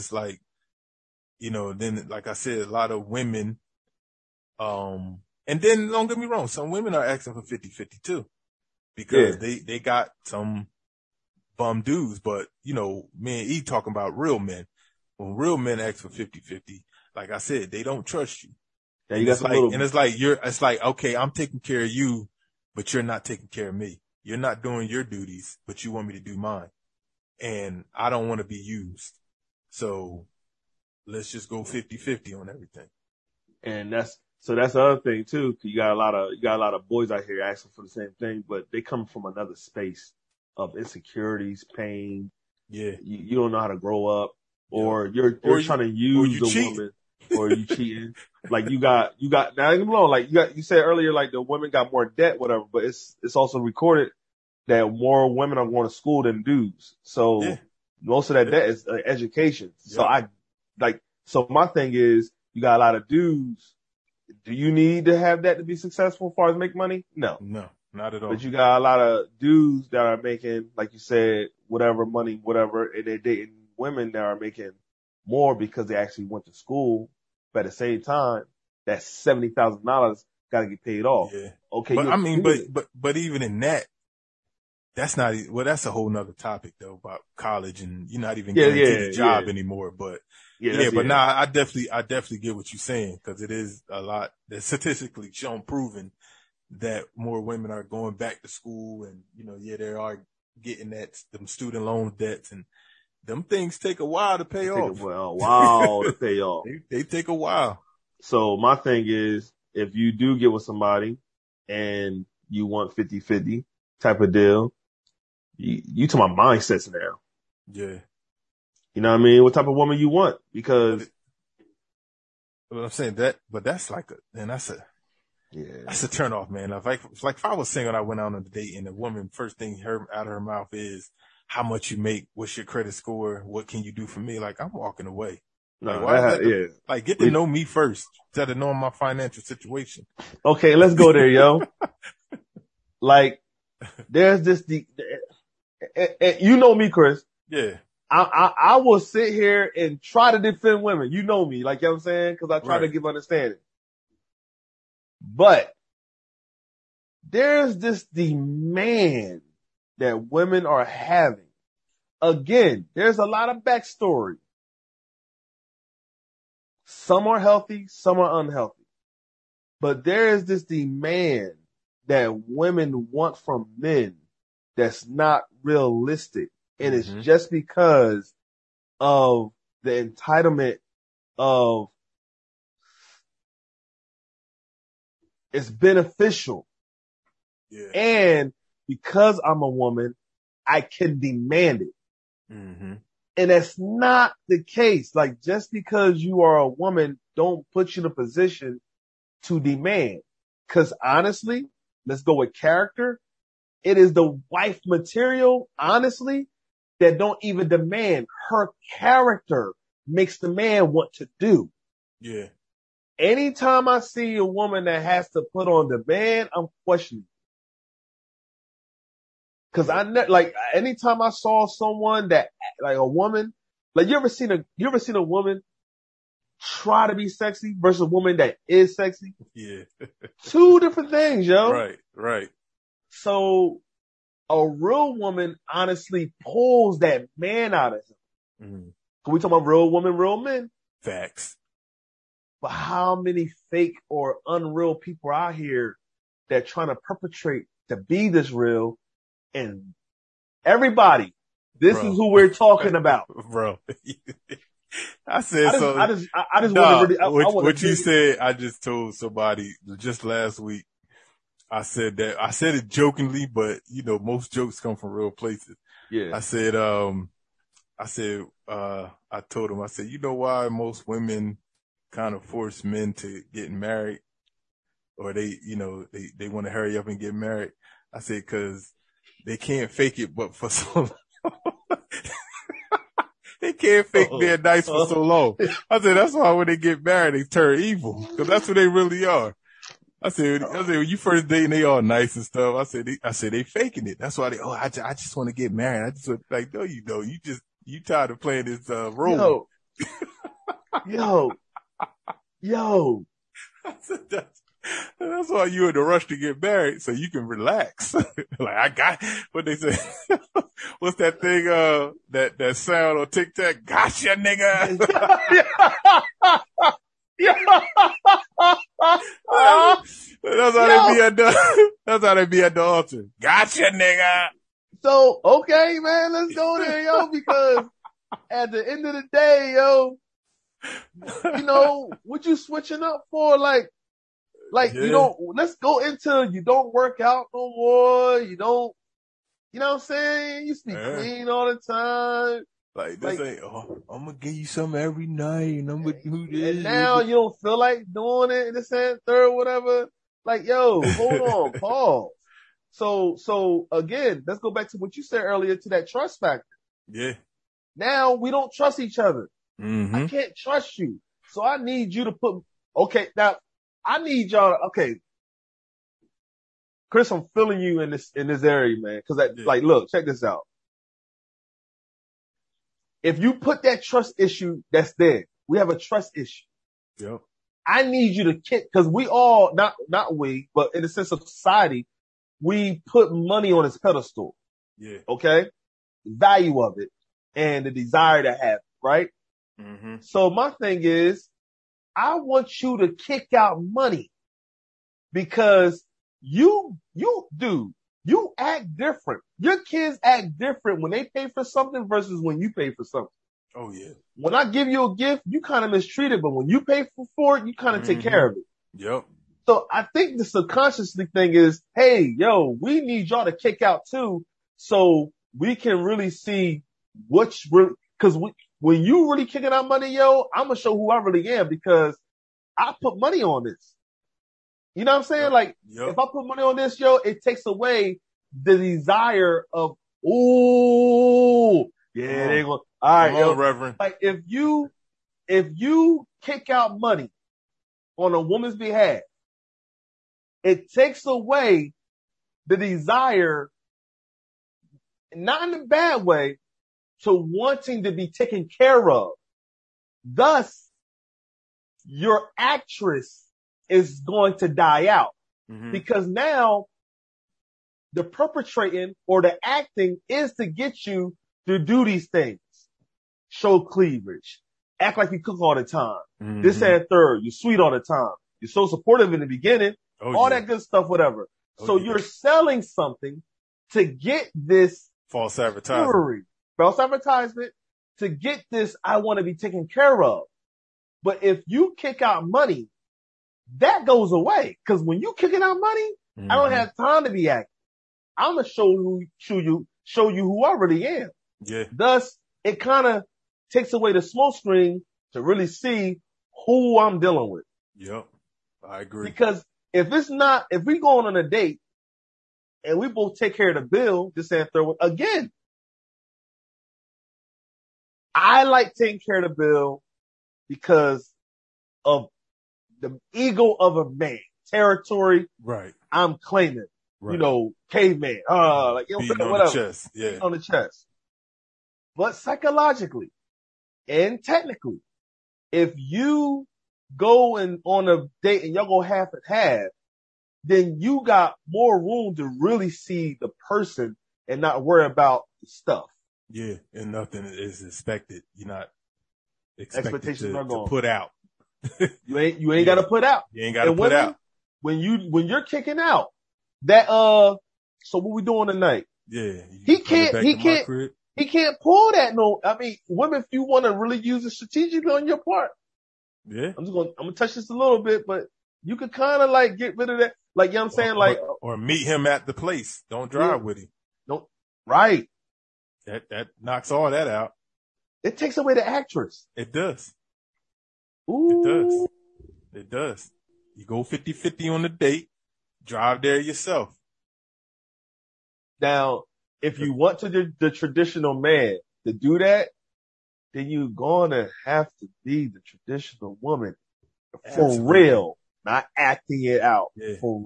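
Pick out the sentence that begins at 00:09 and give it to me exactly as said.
they, they got some bum dudes, but you know, me and E talking about real men.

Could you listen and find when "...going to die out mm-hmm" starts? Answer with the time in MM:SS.
07:34.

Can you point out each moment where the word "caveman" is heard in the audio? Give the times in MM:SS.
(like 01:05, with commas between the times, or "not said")
08:37.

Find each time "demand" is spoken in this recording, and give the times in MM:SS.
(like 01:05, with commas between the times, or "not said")
02:38, 02:50, 03:11, 03:19, 03:27, 03:35.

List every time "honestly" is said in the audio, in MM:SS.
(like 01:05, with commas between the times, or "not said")
03:21, 03:25, 03:55.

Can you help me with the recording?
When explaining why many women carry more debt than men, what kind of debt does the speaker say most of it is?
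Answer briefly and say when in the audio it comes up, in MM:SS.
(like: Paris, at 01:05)
education, at 00:59.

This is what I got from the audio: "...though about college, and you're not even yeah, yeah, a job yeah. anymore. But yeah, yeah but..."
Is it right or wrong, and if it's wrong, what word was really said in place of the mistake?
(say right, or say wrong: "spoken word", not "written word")
right.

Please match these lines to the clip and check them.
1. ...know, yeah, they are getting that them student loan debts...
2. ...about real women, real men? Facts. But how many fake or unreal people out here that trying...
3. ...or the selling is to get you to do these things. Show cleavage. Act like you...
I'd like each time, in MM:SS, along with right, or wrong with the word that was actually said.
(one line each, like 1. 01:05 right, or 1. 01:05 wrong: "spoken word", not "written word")
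1. 01:39 right
2. 03:59 right
3. 07:39 wrong: "acting", not "selling".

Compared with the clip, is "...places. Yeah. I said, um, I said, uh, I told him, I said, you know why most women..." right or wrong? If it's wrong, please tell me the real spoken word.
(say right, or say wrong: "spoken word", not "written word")
right.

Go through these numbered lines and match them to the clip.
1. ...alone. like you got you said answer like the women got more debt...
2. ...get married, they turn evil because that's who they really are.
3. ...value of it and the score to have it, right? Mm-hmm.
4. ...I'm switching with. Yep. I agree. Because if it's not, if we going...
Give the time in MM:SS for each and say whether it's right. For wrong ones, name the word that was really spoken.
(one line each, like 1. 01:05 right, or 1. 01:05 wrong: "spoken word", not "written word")
1. 00:49 wrong: "earlier", not "answer"
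2. 04:46 right
3. 06:26 wrong: "desire", not "score"
4. 08:16 wrong: "dealing", not "switching".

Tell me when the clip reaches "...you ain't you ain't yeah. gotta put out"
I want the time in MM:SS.
09:02.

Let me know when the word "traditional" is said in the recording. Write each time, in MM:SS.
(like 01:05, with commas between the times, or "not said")
09:40, 09:45.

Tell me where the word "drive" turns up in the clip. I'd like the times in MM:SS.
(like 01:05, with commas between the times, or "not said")
09:23, 09:35.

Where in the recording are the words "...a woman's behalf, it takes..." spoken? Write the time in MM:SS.
07:18.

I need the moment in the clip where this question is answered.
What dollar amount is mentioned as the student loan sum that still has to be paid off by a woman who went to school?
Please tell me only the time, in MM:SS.
01:18.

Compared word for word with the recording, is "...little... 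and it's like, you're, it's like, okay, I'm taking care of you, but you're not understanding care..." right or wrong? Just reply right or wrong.
wrong.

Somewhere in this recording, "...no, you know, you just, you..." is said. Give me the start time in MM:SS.
04:56.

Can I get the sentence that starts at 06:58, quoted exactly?
because when you really kicking out money, yo, I'm gonna show who I really am because I put money on this.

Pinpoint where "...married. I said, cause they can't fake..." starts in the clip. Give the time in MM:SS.
04:37.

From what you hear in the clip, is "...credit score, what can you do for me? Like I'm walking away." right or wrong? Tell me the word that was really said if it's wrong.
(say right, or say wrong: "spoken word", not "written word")
right.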